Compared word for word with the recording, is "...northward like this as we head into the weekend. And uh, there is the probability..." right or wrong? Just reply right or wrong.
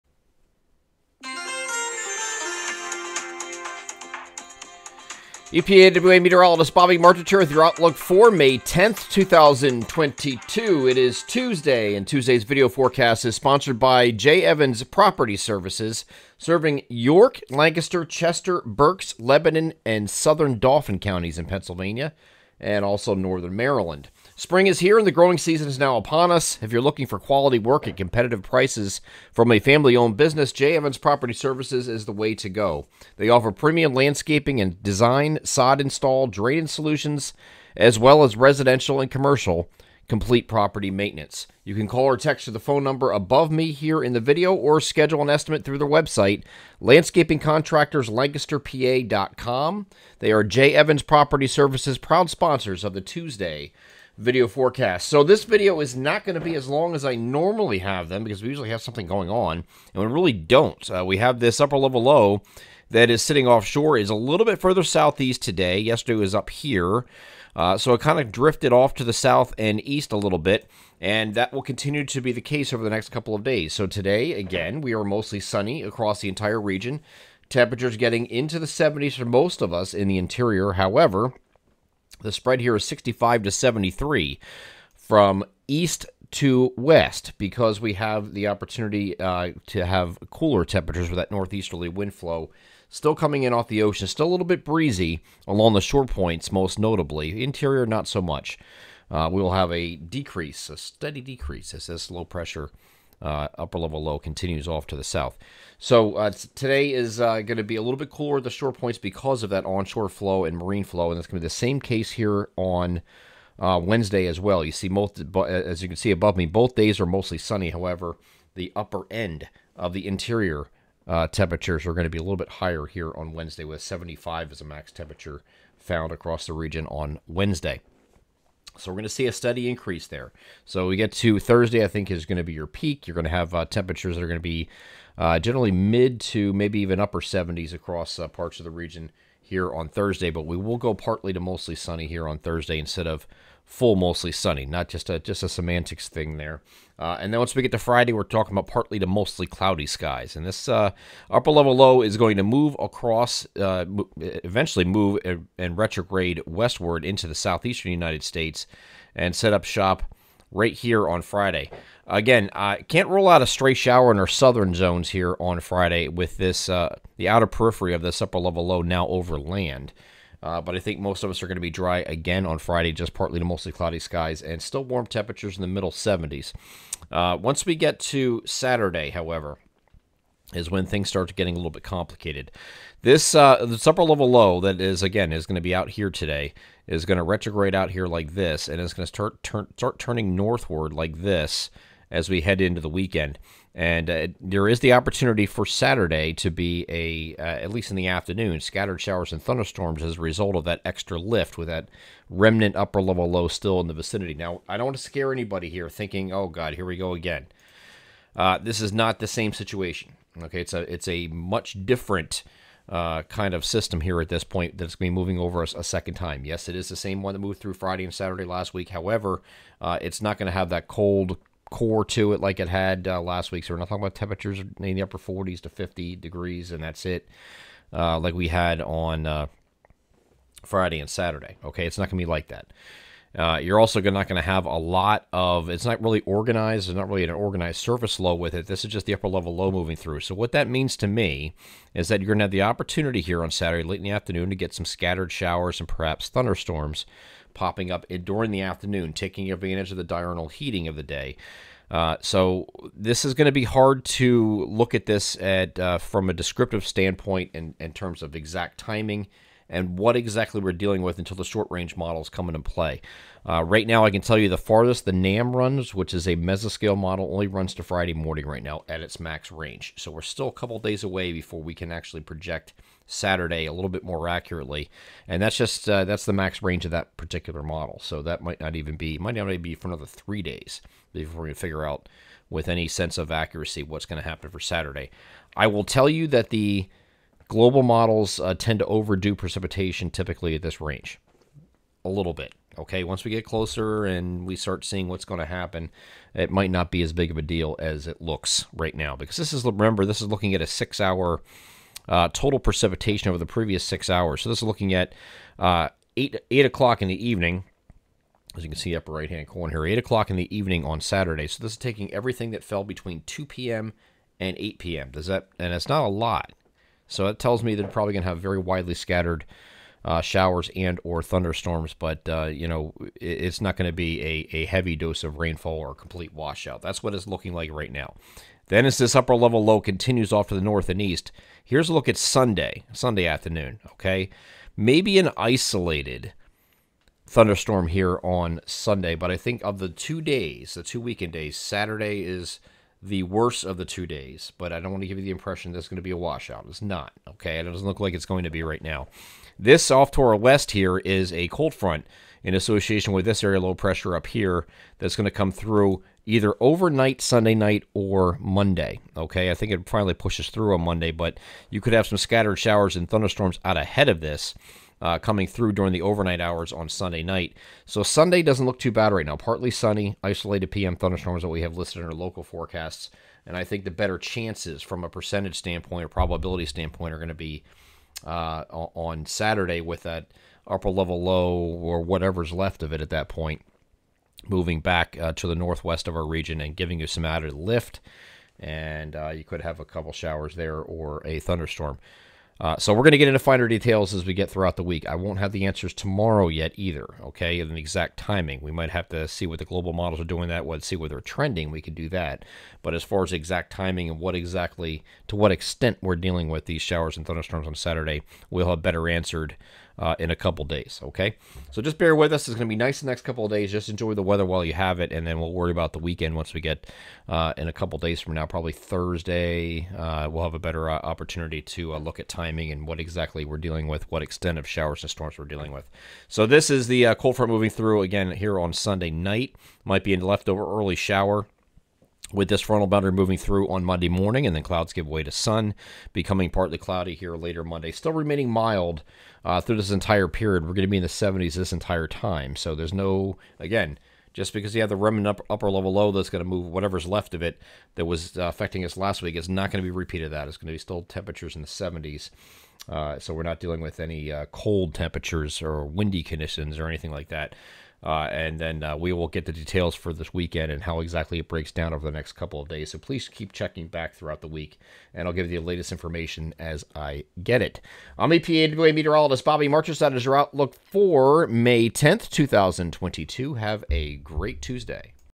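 wrong.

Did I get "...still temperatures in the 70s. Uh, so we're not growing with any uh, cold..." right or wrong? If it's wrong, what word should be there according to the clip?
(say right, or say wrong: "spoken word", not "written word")
wrong: "dealing", not "growing".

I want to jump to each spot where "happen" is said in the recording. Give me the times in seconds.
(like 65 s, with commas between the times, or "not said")
284 s, 295 s.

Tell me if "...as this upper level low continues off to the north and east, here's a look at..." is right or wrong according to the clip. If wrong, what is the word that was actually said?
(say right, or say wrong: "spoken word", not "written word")
right.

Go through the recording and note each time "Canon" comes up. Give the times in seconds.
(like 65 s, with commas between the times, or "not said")
not said.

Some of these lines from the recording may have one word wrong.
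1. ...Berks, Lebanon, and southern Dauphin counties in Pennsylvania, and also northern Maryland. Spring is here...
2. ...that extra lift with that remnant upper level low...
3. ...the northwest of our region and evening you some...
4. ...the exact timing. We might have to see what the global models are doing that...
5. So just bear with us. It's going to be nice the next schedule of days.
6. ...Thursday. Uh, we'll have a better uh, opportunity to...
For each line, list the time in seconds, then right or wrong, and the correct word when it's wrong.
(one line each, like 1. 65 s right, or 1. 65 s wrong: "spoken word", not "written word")
1. 18 s right
2. 200 s right
3. 385 s wrong: "giving", not "evening"
4. 397 s right
5. 411 s wrong: "couple", not "schedule"
6. 418 s right.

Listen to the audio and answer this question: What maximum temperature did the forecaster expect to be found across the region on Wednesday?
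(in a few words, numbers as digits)
75.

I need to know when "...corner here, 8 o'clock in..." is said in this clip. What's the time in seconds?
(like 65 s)
309 s.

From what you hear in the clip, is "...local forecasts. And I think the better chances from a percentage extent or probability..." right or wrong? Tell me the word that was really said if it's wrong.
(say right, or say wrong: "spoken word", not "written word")
wrong: "standpoint", not "extent".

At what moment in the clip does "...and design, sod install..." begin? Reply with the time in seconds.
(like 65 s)
34 s.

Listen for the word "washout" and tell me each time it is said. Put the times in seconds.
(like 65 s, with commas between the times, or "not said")
326 s, 346 s.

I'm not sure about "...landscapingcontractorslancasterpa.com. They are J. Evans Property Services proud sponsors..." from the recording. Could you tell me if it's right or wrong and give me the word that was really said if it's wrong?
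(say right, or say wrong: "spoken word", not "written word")
right.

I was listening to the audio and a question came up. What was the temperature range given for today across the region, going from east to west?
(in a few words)
65 to 73.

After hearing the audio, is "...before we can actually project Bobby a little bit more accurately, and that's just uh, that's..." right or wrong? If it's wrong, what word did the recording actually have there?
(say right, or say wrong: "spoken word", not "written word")
wrong: "Saturday", not "Bobby".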